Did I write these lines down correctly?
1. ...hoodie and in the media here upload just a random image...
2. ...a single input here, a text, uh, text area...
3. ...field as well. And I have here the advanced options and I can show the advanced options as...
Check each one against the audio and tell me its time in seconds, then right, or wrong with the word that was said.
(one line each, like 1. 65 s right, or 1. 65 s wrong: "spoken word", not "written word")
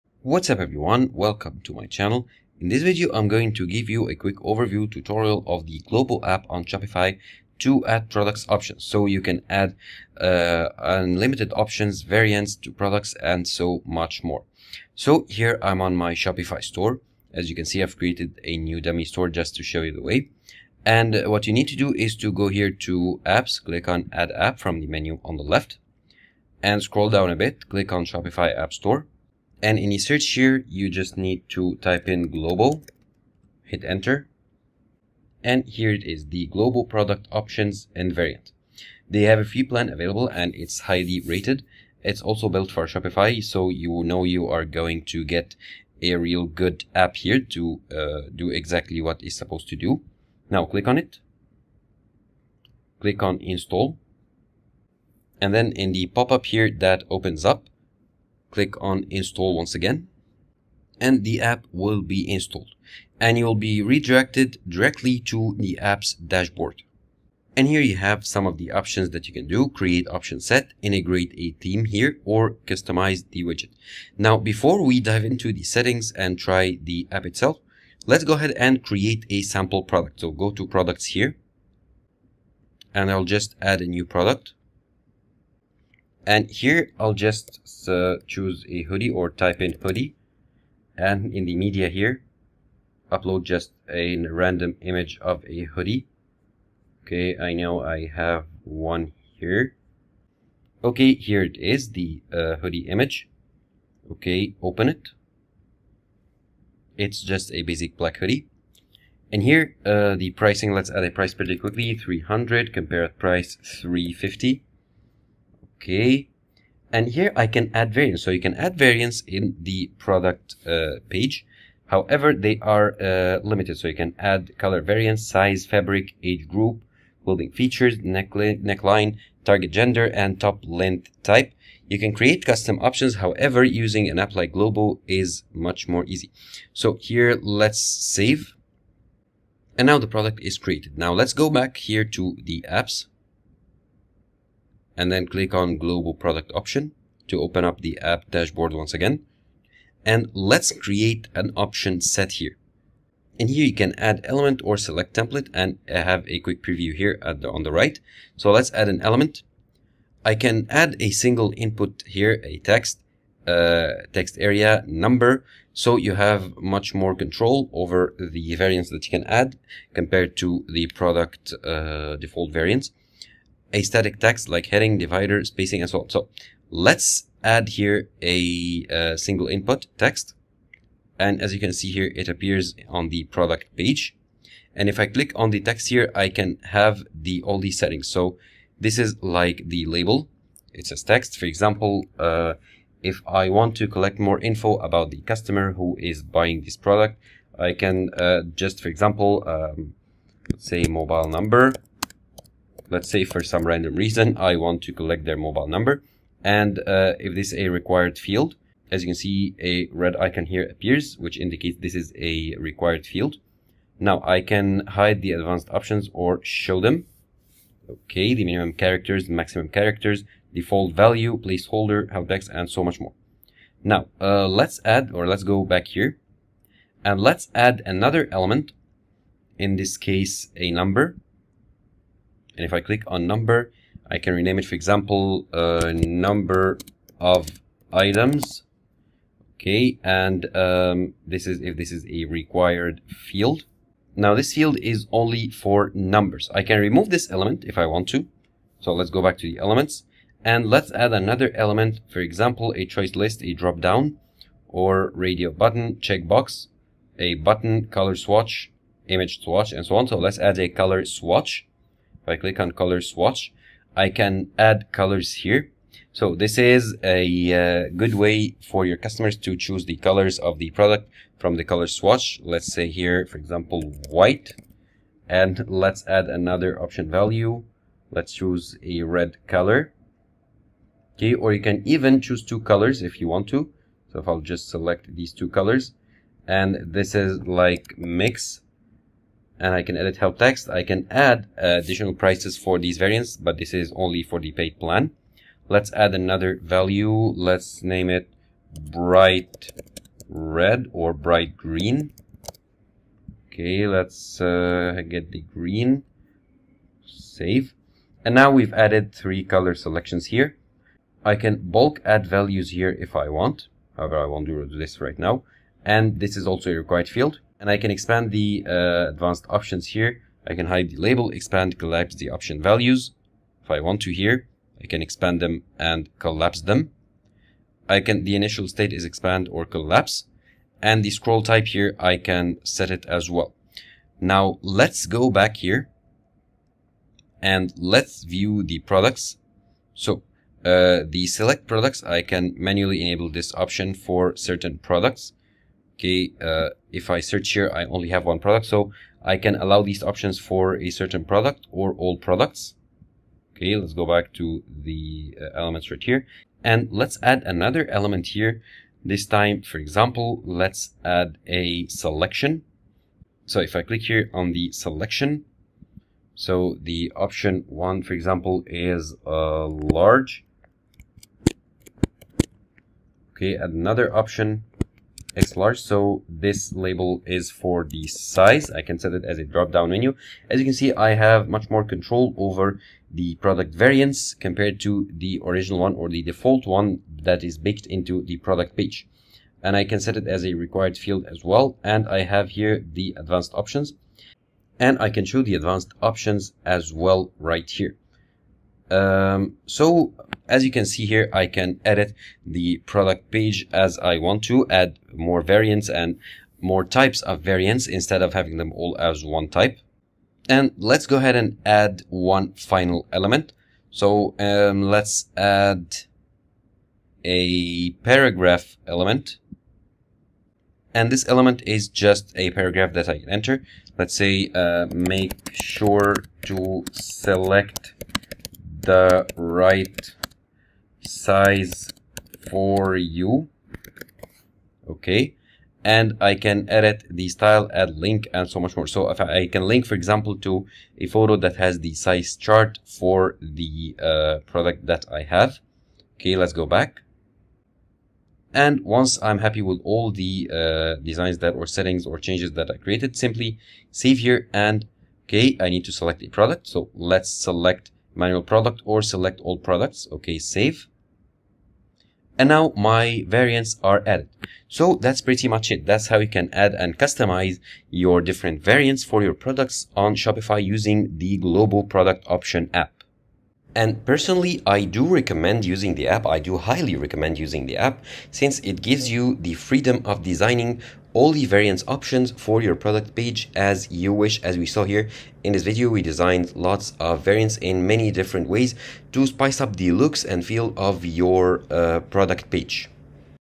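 1. 89 s right
2. 160 s right
3. 390 s right.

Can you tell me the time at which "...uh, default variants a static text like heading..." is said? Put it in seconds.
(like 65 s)
171 s.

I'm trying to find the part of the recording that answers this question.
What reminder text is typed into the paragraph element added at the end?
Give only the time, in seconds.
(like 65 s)
424 s.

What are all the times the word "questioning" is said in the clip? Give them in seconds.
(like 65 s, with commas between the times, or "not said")
not said.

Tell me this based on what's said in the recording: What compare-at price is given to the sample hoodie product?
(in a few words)
350.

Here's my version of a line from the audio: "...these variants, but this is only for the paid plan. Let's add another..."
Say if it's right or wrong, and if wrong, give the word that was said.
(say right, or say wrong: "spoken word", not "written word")
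right.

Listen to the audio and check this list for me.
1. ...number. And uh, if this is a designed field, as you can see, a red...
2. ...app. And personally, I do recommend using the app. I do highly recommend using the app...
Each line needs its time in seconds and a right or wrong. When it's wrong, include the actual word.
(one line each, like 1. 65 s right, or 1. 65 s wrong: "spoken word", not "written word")
1. 205 s wrong: "required", not "designed"
2. 472 s right.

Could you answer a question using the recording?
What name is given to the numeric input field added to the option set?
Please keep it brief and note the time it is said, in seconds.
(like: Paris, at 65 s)
Number of items, at 235 s.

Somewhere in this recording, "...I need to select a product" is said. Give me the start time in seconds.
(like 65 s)
455 s.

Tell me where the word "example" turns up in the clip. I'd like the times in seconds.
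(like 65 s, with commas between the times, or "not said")
191 s, 198 s, 234 s, 252 s, 273 s, 359 s, 368 s, 439 s.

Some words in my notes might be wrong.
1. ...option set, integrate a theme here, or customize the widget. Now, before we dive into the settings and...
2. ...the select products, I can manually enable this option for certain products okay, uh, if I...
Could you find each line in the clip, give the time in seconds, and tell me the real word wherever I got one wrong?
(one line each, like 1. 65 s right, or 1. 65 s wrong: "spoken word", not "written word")
1. 70 s right
2. 341 s right.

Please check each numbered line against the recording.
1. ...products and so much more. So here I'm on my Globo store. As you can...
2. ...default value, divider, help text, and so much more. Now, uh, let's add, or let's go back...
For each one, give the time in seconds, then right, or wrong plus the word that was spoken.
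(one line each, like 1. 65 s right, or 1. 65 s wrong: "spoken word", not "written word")
1. 12 s wrong: "Shopify", not "Globo"
2. 220 s wrong: "placeholder", not "divider".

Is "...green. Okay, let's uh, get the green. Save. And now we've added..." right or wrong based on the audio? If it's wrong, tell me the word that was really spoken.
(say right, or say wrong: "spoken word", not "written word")
right.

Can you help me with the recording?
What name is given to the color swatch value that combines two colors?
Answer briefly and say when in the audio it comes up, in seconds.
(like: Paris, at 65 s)
Mix, at 287 s.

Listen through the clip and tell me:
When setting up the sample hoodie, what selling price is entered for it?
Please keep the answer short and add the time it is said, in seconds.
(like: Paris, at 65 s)
300, at 111 s.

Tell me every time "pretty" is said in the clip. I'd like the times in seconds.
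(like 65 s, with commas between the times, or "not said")
111 s, 465 s.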